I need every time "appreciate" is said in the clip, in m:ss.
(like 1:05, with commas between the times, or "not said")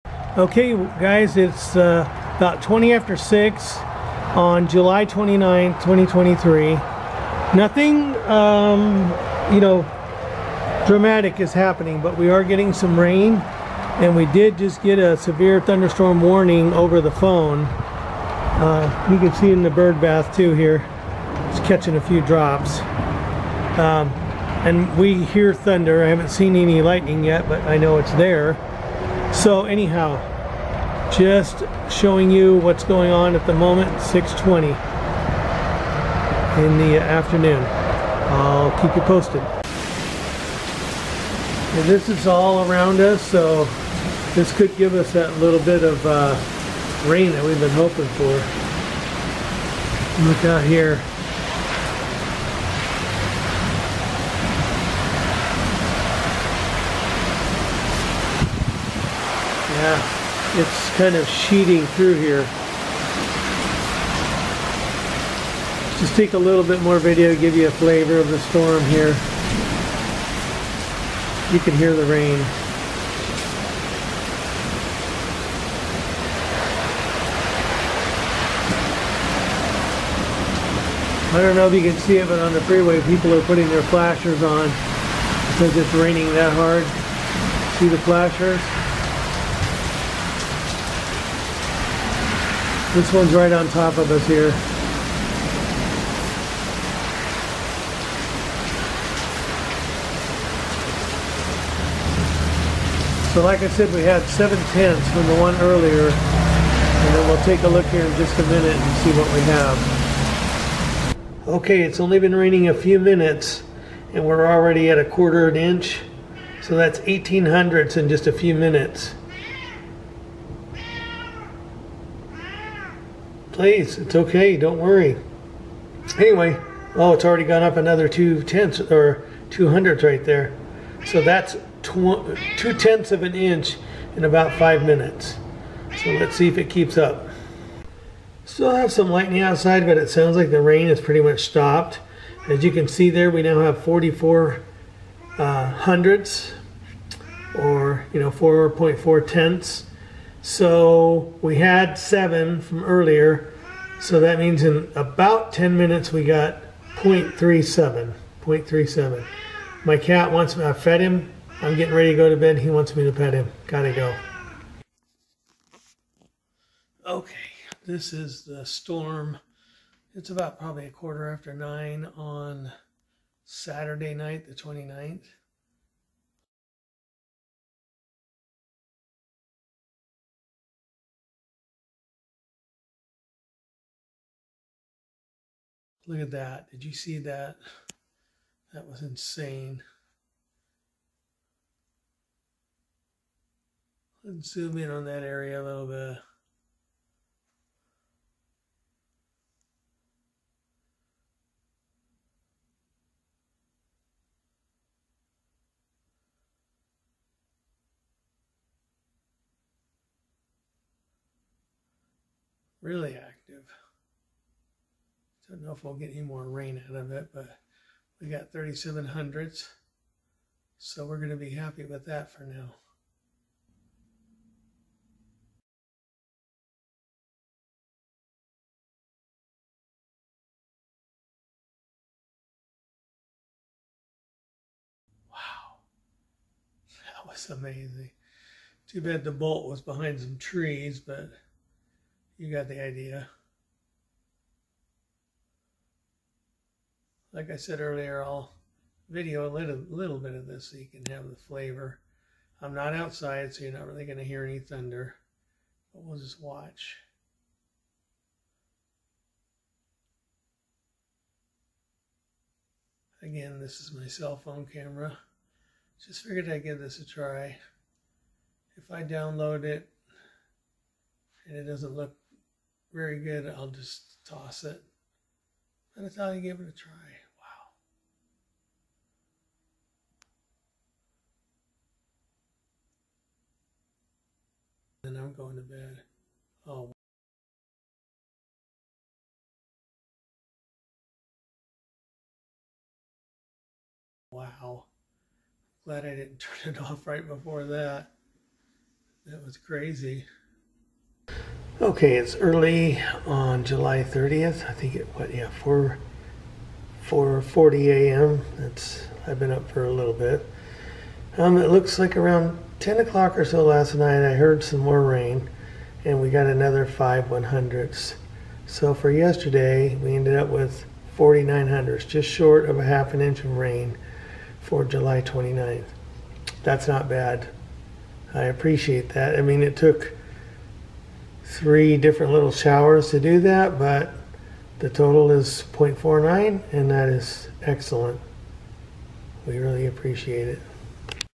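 5:28, 5:39.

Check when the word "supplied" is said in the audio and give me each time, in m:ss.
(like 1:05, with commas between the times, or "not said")
not said.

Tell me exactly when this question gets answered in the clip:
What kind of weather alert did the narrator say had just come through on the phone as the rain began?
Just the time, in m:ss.
0:15.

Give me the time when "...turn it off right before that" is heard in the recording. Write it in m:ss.
4:56.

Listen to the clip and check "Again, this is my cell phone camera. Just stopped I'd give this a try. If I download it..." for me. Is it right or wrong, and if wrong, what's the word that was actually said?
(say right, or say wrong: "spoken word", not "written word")
wrong: "figured", not "stopped".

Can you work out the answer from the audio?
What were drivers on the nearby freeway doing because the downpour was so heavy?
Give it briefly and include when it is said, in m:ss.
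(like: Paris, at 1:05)
putting their flashers on, at 1:23.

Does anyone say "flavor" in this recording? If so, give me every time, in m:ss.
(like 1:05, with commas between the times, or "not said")
1:07, 4:11.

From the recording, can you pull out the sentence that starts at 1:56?
So that's 18 hundredths in just a few minutes.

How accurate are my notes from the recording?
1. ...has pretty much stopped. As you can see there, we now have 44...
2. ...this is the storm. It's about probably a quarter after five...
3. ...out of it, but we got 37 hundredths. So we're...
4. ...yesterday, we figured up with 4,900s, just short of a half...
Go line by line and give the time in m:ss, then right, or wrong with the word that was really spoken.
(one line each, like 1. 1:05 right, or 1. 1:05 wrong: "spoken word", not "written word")
1. 2:20 right
2. 2:47 wrong: "nine", not "five"
3. 3:36 right
4. 5:19 wrong: "ended", not "figured".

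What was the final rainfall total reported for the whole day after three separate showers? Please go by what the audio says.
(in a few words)
0.49 inch.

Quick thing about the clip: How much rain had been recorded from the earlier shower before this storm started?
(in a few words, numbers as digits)
0.7 inch.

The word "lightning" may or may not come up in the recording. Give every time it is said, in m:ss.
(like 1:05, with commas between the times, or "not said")
0:26, 2:19.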